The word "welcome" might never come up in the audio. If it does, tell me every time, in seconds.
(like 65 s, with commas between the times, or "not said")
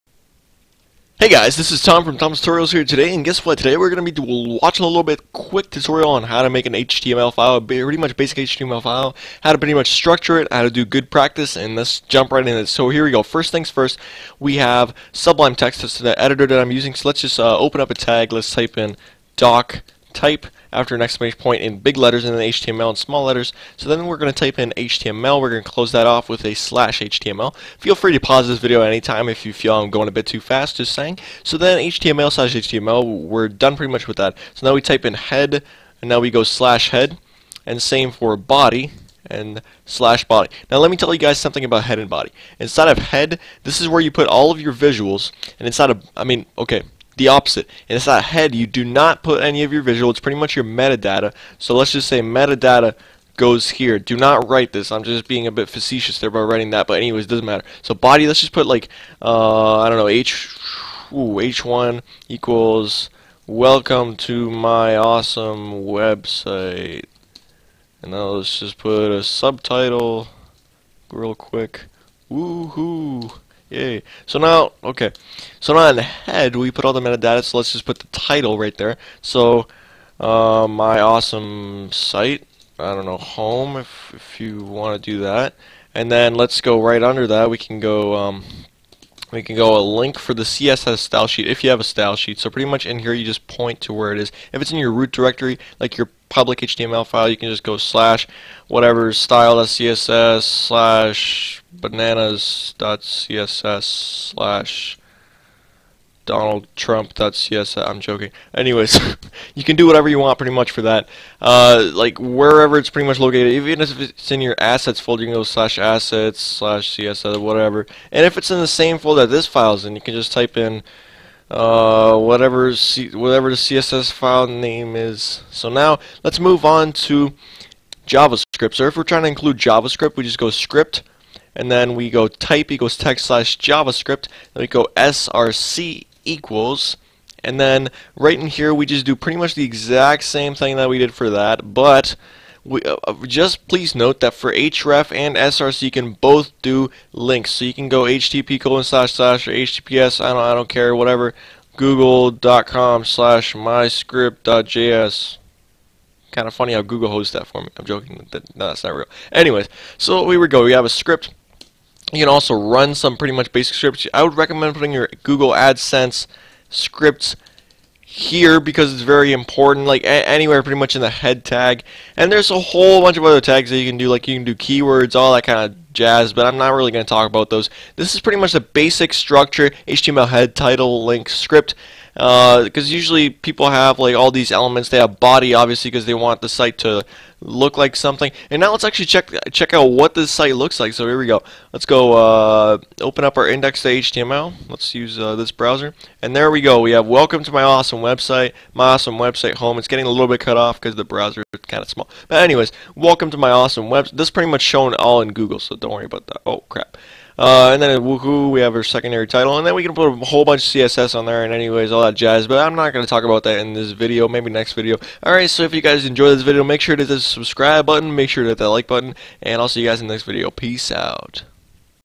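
63 s, 197 s, 202 s.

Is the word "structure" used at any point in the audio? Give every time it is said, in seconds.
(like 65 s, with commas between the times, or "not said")
9 s, 179 s.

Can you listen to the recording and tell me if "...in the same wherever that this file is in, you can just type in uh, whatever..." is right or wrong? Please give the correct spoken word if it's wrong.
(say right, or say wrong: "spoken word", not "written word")
wrong: "folder", not "wherever".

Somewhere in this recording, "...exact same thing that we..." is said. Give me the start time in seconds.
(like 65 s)
139 s.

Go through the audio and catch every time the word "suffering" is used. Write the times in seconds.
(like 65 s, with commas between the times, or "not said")
not said.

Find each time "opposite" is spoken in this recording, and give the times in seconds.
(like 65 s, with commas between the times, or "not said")
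47 s.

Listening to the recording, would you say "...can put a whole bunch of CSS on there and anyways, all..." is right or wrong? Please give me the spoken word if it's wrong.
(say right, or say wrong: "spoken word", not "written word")
right.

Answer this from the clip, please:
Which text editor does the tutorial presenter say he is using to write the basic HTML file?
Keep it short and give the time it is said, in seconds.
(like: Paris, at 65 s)
Sublime Text, at 15 s.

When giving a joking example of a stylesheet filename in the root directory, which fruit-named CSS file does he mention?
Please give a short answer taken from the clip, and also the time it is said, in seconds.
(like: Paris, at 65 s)
bananas.css, at 101 s.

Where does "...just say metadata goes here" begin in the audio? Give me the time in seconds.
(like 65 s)
51 s.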